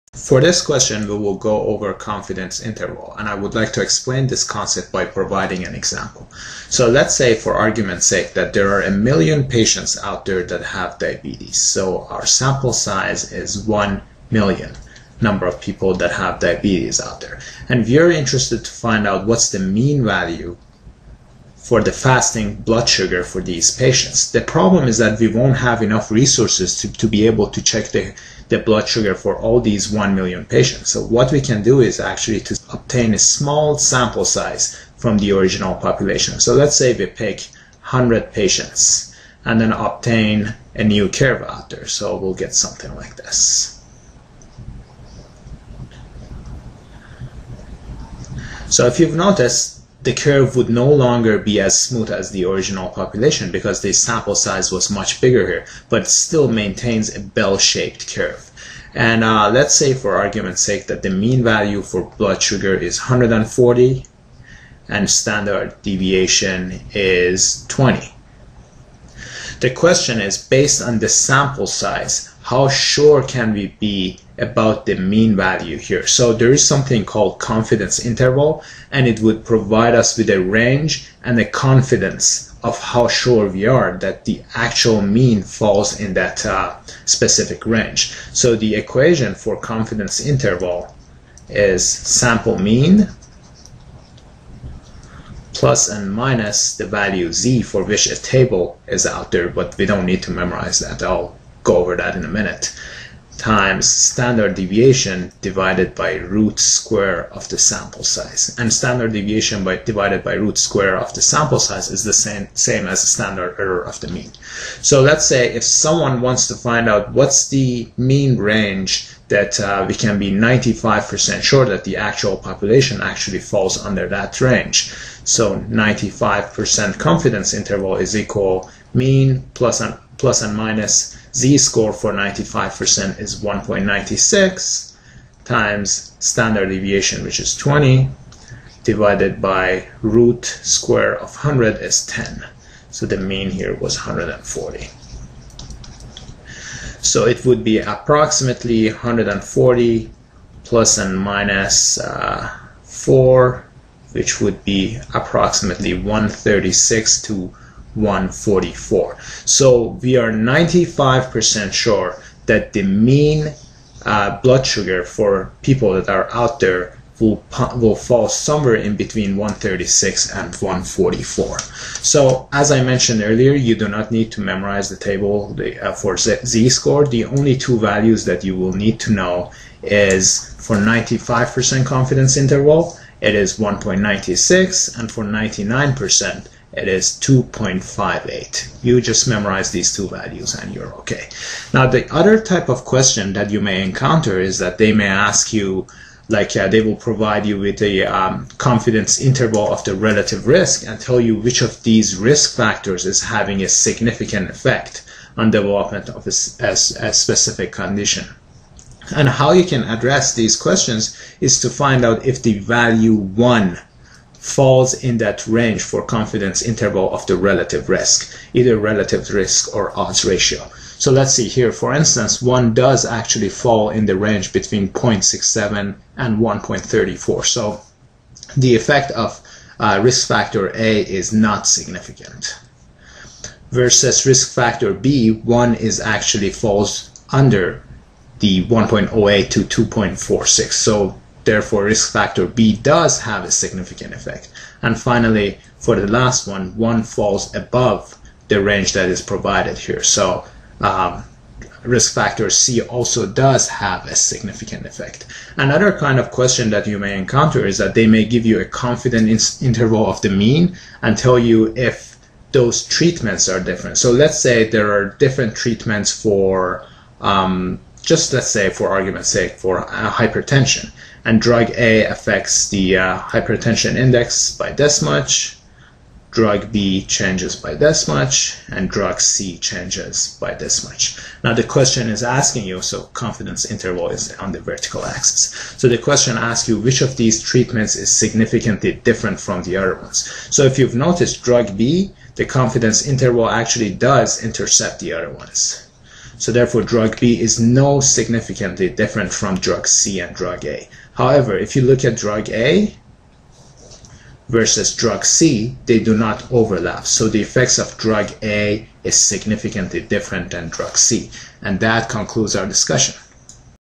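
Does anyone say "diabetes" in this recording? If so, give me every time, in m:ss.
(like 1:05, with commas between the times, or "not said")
0:10, 0:16.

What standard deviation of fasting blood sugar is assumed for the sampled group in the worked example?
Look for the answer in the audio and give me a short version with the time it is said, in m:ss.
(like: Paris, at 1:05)
20, at 1:05.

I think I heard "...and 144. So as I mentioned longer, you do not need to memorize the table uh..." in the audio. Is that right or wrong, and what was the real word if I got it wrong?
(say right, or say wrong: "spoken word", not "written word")
wrong: "earlier", not "longer".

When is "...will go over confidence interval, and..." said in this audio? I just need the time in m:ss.
0:01.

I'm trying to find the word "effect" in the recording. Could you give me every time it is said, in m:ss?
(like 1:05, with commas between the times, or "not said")
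3:24, 3:48, 4:04, 4:14, 5:07.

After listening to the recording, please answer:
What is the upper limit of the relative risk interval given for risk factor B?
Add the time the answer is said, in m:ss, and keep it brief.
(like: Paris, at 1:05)
2.46, at 3:59.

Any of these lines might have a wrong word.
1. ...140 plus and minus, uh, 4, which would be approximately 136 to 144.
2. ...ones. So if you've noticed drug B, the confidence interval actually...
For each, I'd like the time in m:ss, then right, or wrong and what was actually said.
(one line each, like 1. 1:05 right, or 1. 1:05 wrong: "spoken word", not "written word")
1. 2:28 right
2. 4:49 right.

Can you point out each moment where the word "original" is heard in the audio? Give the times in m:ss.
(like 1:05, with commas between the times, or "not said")
0:35, 0:52.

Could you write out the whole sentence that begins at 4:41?
Now the question is asking you, so confidence interval is on the vertical axis.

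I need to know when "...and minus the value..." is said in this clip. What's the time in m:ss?
1:35.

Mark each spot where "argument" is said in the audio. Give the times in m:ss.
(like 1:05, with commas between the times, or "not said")
0:07, 1:00, 4:28.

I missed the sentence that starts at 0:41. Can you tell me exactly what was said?
So we'll get something like this.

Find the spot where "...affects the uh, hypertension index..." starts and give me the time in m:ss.
4:32.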